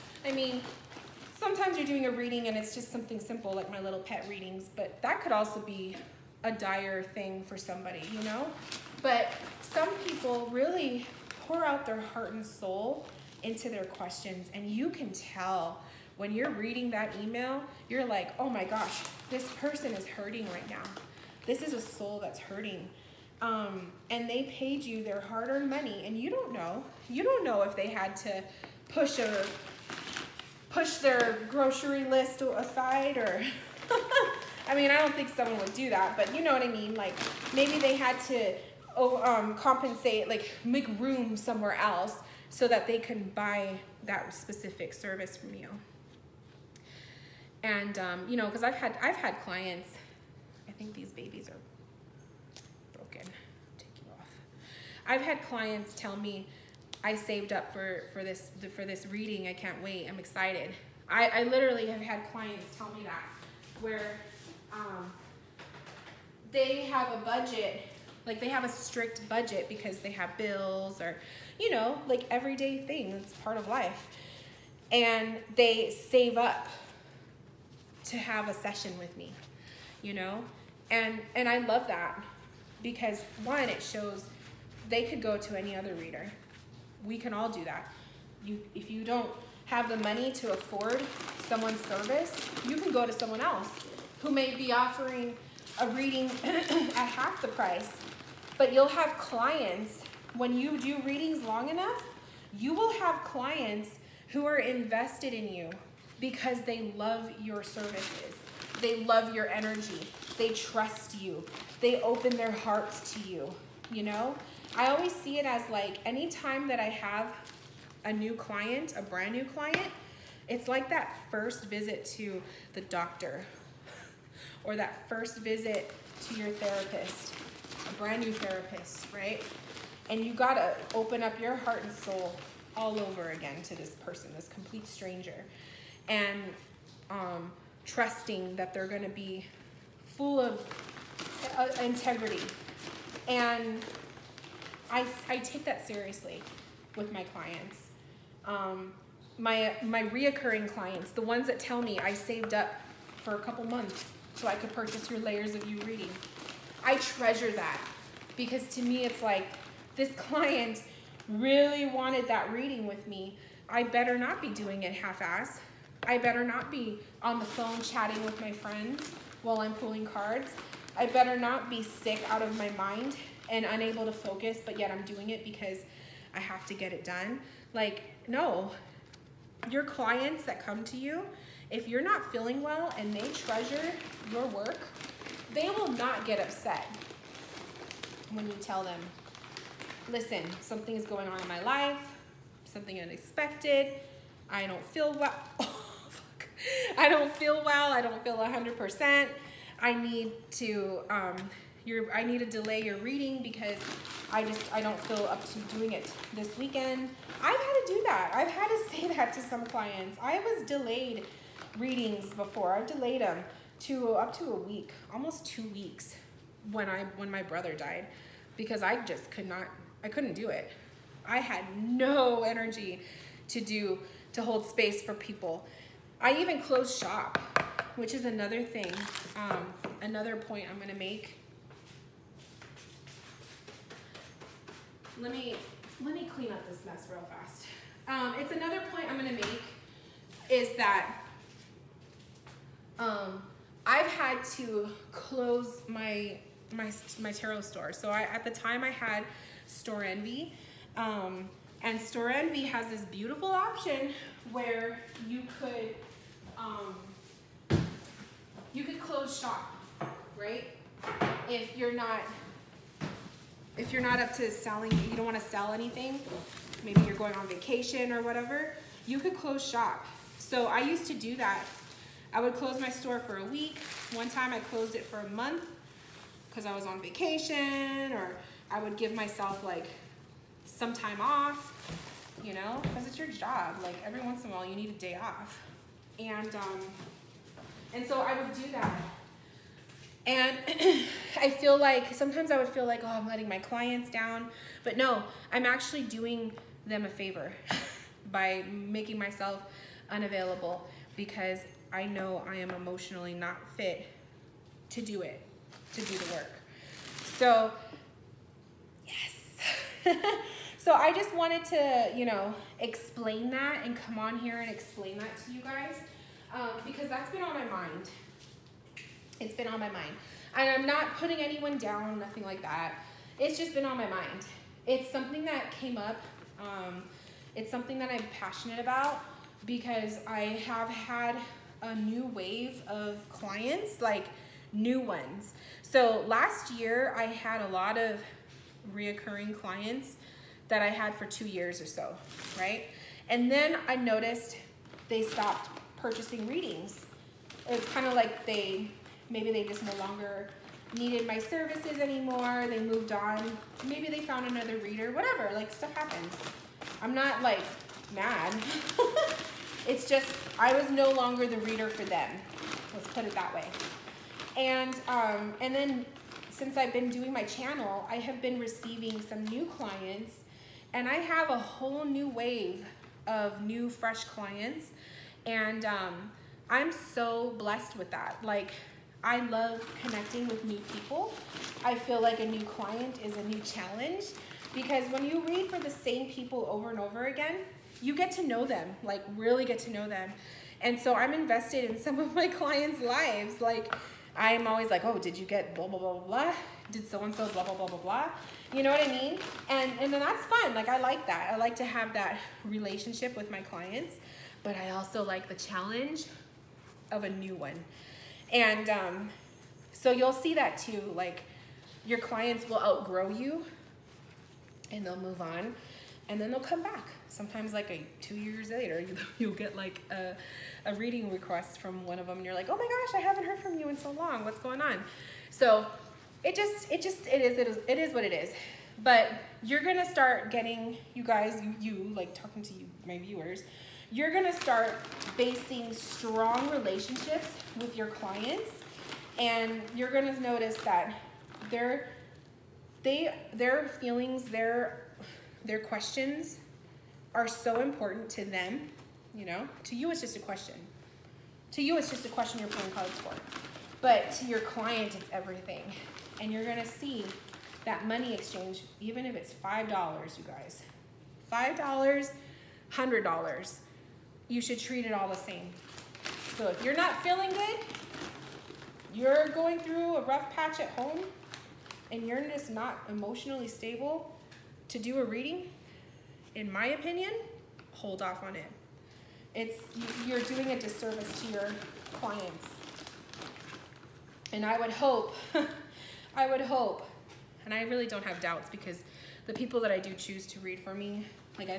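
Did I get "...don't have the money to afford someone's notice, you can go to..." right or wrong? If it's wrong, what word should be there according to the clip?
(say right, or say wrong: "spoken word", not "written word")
wrong: "service", not "notice".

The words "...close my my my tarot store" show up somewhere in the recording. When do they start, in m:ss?
4:05.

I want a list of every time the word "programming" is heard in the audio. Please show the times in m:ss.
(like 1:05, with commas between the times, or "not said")
not said.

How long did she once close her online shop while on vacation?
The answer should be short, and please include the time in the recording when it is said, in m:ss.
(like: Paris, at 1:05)
a month, at 4:35.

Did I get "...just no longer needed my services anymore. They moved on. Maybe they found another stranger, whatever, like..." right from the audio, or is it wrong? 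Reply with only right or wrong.
wrong.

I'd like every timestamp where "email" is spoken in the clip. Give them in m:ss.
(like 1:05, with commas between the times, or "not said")
0:17.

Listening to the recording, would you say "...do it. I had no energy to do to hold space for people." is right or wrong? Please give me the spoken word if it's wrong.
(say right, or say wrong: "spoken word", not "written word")
right.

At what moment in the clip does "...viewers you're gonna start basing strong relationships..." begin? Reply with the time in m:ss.
7:13.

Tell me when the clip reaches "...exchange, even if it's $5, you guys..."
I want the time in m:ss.
7:38.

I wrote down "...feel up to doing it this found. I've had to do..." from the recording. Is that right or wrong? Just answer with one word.
wrong.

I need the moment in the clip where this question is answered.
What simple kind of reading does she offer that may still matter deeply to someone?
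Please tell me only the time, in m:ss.
0:03.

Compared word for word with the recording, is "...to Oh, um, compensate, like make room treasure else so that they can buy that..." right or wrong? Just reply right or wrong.
wrong.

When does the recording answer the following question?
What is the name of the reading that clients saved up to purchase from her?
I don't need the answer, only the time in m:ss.
2:35.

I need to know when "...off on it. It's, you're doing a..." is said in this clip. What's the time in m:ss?
7:58.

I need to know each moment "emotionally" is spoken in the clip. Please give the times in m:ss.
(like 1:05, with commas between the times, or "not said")
5:02, 7:53.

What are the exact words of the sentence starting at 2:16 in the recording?
And um, trusting that they're gonna be full of uh, integrity.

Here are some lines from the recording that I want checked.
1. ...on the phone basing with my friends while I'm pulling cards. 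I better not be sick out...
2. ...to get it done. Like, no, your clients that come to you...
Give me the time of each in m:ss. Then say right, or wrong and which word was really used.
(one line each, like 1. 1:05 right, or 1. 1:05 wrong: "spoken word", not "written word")
1. 2:47 wrong: "chatting", not "basing"
2. 2:56 right.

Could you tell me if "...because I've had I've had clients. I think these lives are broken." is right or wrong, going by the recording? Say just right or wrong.
wrong.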